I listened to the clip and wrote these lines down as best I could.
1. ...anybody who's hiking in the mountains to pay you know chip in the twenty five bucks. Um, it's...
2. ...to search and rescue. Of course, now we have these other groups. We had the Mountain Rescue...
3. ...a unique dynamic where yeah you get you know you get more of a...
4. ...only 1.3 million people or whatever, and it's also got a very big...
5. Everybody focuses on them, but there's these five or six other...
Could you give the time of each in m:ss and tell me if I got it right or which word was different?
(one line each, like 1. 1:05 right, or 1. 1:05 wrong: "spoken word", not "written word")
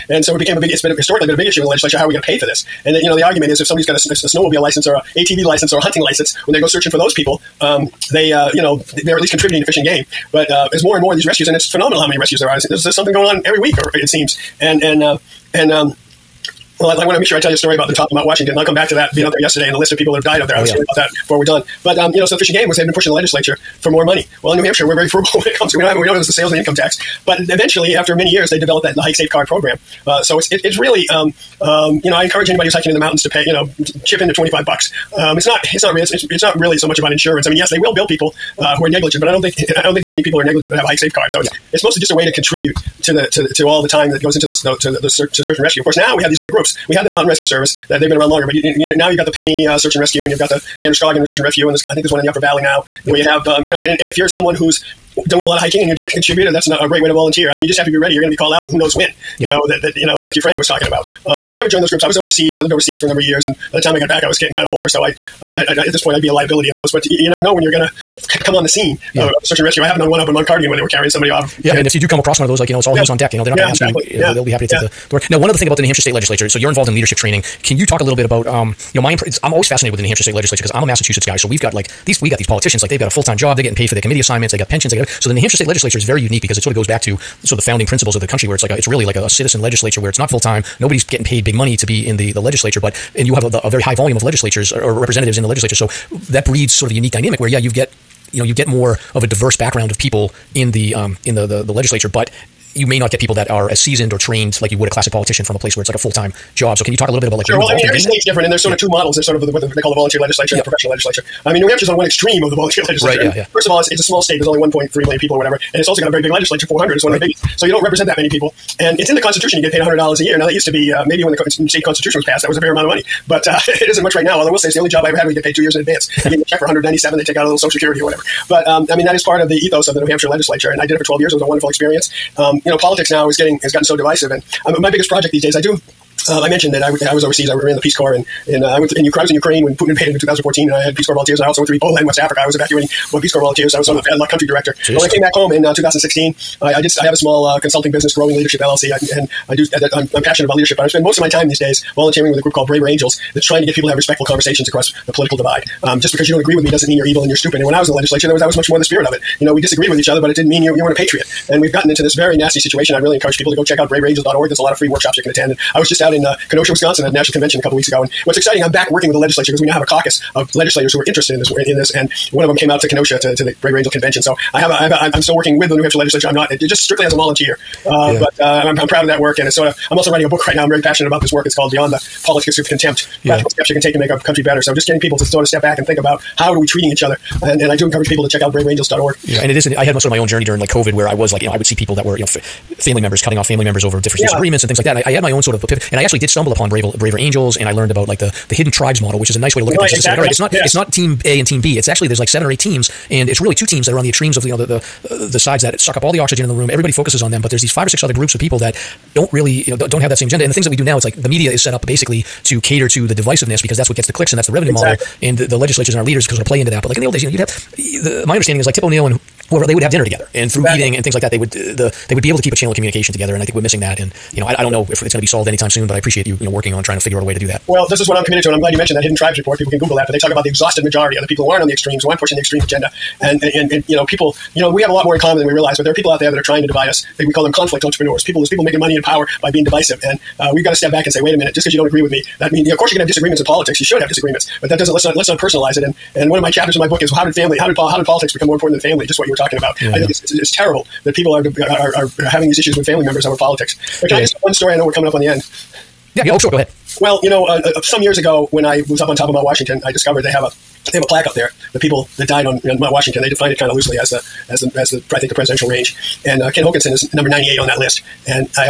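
1. 0:32 right
2. 0:45 right
3. 1:36 right
4. 1:54 right
5. 3:26 right.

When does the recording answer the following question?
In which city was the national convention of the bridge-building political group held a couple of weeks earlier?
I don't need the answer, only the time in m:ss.
2:46.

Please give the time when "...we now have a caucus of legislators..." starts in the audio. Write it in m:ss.
2:49.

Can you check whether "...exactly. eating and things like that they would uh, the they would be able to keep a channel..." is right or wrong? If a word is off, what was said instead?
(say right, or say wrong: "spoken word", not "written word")
right.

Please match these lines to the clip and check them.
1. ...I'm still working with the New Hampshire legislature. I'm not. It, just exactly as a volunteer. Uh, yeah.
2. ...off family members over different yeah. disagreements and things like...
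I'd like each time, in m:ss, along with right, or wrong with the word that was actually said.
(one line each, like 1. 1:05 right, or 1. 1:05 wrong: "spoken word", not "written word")
1. 2:55 wrong: "strictly", not "exactly"
2. 3:13 right.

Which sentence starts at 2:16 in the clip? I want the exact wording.
Uh, I mentioned that I, w- I was overseas.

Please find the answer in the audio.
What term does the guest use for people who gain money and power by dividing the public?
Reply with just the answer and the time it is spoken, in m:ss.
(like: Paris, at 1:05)
conflict entrepreneurs, at 3:57.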